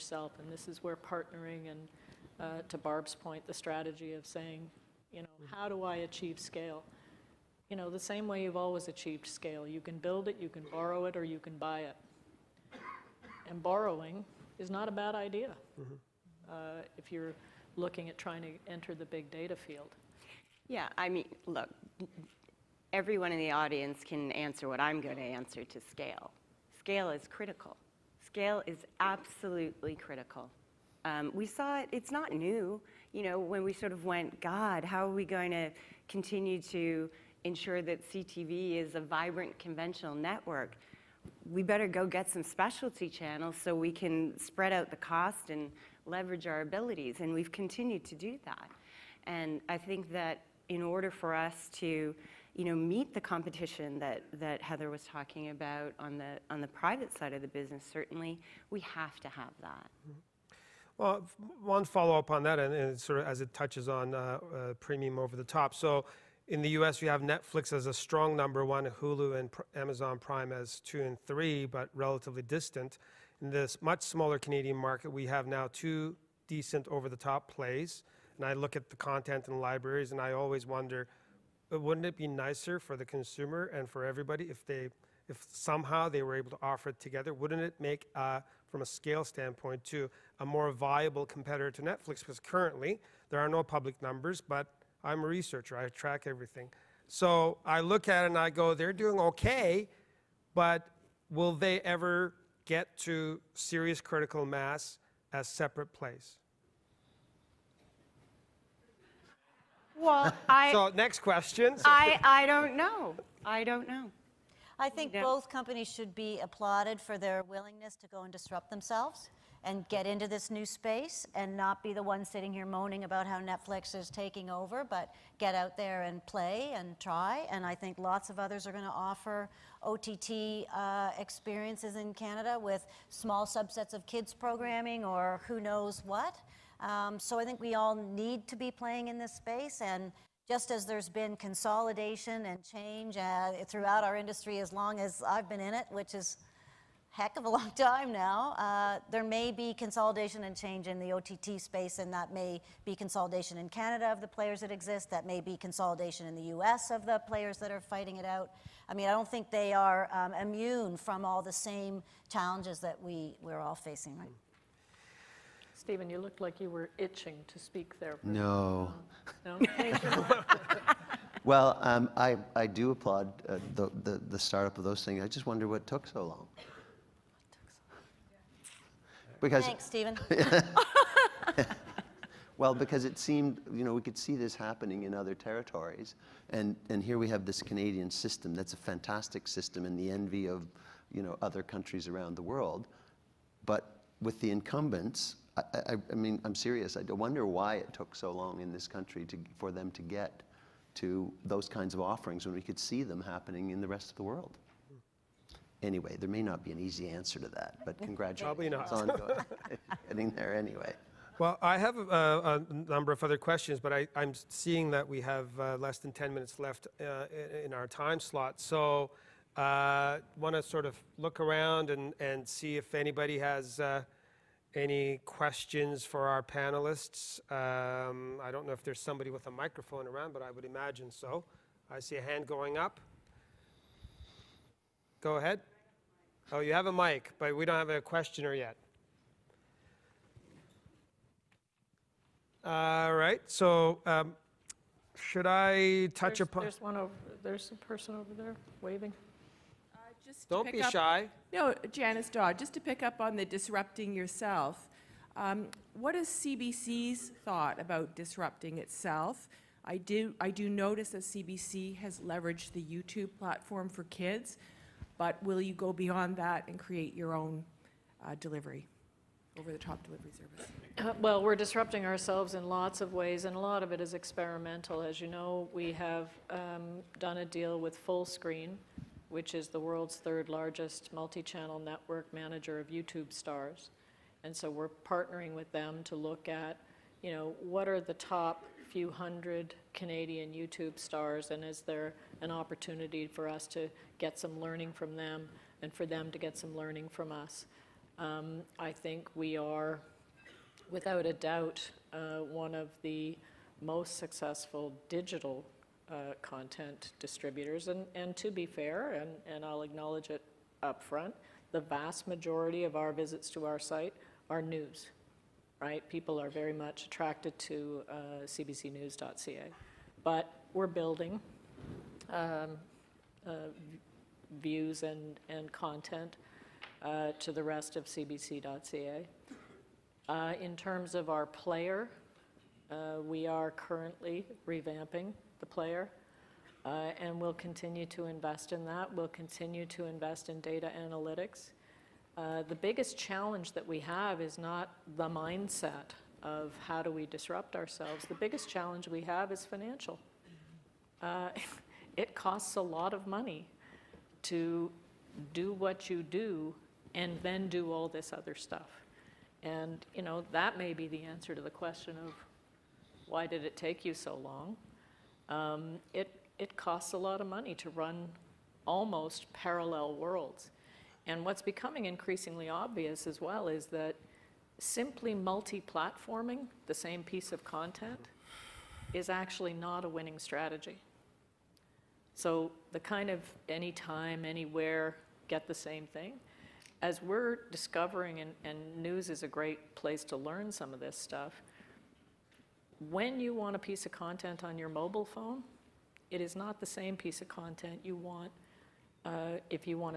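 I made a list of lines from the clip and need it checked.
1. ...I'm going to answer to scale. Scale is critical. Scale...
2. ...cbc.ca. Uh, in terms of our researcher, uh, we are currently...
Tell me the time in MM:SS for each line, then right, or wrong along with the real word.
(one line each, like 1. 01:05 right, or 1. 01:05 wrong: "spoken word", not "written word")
1. 00:24 right
2. 05:28 wrong: "player", not "researcher".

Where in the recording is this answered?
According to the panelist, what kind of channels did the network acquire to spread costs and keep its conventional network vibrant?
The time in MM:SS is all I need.
00:42.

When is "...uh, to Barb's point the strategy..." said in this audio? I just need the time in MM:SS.
00:02.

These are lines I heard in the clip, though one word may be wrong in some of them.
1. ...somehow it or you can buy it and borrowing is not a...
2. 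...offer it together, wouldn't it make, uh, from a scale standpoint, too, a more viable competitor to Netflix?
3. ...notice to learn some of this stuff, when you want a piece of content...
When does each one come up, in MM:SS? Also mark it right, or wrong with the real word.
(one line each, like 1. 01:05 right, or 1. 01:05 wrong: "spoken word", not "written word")
1. 00:10 wrong: "borrow", not "somehow"
2. 01:26 right
3. 06:29 wrong: "place", not "notice".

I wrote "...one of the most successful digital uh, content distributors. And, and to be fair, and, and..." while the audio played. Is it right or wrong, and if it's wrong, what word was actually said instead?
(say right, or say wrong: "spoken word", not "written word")
right.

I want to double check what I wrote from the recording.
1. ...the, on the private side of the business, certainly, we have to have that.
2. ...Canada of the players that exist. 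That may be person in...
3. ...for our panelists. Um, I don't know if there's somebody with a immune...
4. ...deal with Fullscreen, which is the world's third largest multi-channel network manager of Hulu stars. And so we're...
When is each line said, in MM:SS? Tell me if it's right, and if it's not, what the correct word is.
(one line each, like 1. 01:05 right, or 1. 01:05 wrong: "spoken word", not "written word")
1. 00:56 right
2. 02:33 wrong: "consolidation", not "person"
3. 03:46 wrong: "microphone", not "immune"
4. 04:37 wrong: "YouTube", not "Hulu".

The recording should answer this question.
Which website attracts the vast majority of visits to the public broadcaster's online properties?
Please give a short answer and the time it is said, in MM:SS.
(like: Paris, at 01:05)
cbcnews.ca, at 05:18.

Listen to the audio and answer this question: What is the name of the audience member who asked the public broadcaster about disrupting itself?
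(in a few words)
Janice Dodd.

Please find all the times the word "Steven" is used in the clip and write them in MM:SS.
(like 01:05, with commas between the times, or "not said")
02:45, 02:59.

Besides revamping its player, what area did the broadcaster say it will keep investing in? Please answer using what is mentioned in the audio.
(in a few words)
data analytics.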